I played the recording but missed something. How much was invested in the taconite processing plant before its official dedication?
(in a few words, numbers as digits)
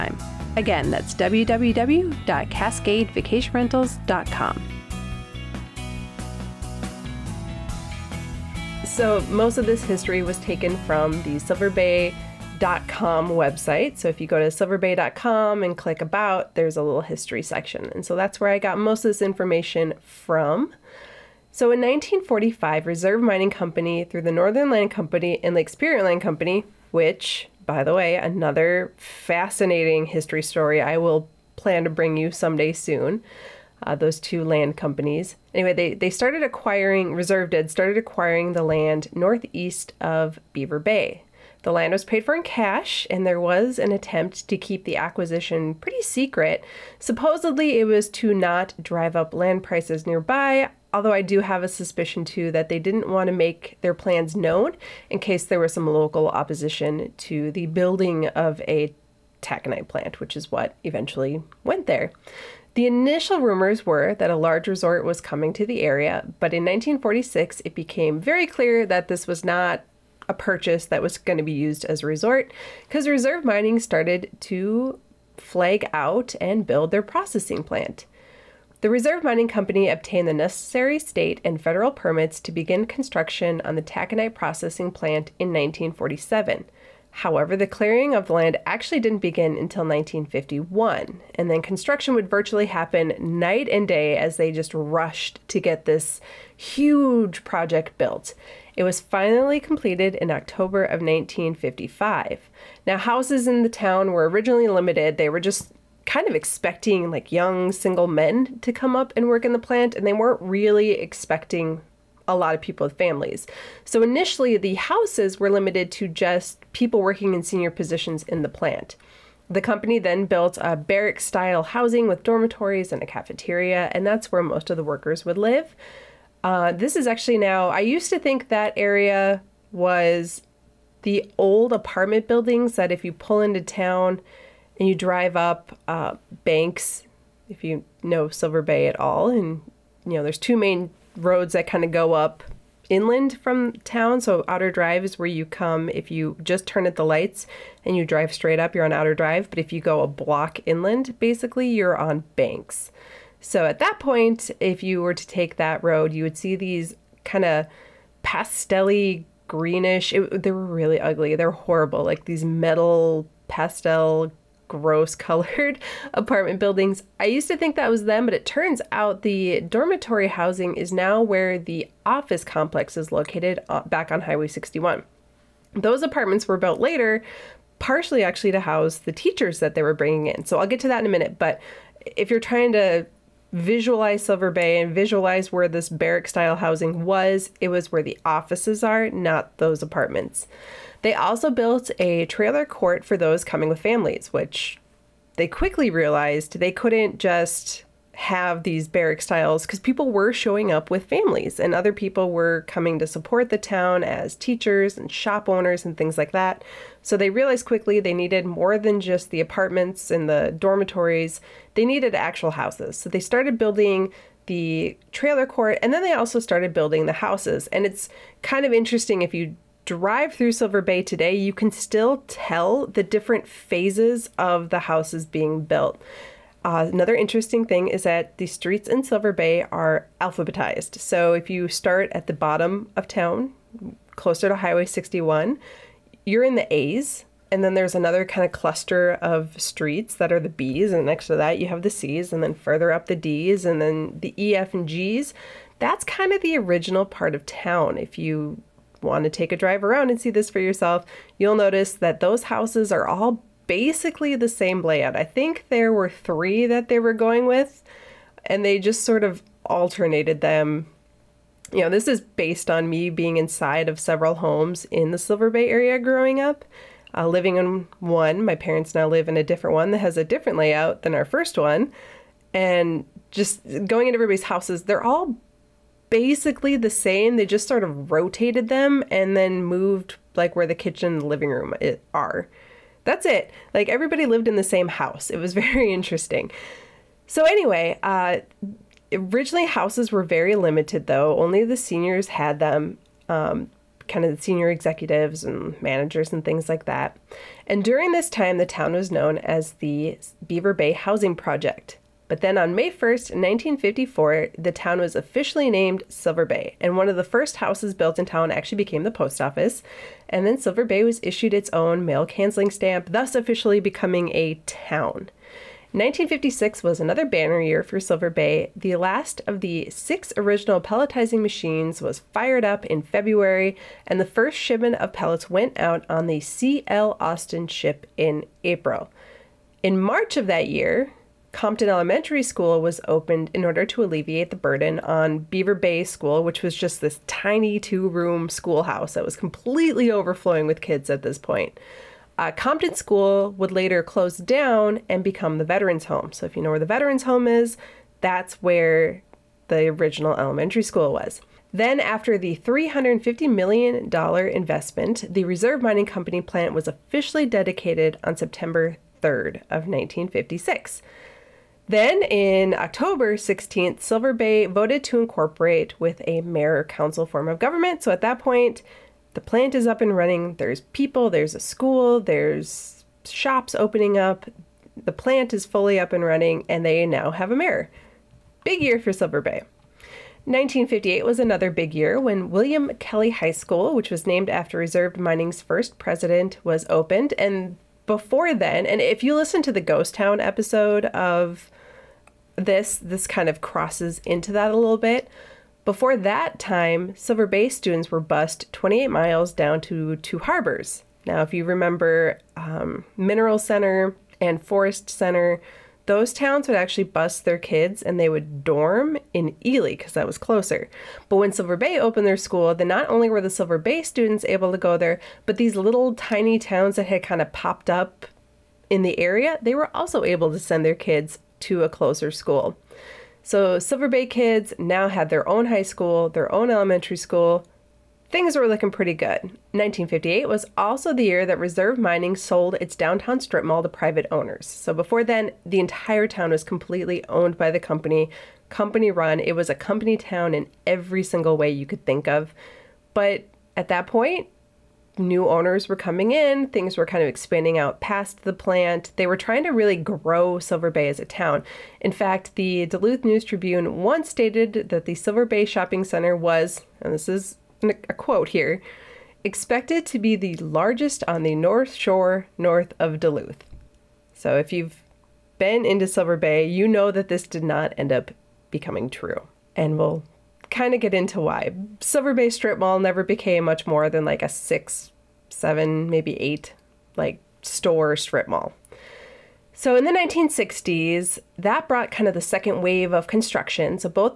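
$350 million.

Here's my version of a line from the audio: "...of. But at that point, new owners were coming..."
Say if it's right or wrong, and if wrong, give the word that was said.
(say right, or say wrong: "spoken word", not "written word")
right.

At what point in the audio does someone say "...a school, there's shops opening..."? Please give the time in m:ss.
6:11.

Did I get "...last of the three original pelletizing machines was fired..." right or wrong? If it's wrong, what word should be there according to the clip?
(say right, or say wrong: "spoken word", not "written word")
wrong: "six", not "three".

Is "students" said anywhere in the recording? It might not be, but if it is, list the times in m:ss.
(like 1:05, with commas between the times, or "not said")
6:37, 6:54.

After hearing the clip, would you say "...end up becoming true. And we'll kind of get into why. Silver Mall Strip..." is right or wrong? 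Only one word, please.
wrong.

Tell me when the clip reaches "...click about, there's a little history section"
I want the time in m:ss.
0:15.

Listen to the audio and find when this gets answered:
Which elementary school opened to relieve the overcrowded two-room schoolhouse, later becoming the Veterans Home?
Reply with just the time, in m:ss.
5:31.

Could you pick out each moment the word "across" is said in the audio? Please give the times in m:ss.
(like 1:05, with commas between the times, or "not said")
not said.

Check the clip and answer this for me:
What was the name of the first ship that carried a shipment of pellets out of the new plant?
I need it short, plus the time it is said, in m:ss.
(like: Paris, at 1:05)
C.L. Austin, at 5:26.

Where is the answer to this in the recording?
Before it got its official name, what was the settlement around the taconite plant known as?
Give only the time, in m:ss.
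5:00.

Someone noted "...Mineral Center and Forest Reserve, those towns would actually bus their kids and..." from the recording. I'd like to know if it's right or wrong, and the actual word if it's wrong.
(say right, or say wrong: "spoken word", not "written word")
wrong: "Center", not "Reserve".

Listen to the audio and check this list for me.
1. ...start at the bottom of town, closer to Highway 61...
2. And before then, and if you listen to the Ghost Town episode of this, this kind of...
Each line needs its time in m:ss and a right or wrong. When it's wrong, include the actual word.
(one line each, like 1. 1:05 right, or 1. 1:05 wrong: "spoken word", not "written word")
1. 3:51 right
2. 6:27 right.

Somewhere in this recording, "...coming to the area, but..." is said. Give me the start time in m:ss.
1:05.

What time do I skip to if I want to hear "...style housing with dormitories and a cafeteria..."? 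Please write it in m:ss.
2:01.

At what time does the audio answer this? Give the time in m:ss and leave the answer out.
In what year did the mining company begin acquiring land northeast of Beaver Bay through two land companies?
0:21.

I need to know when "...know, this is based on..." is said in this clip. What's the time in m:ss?
4:21.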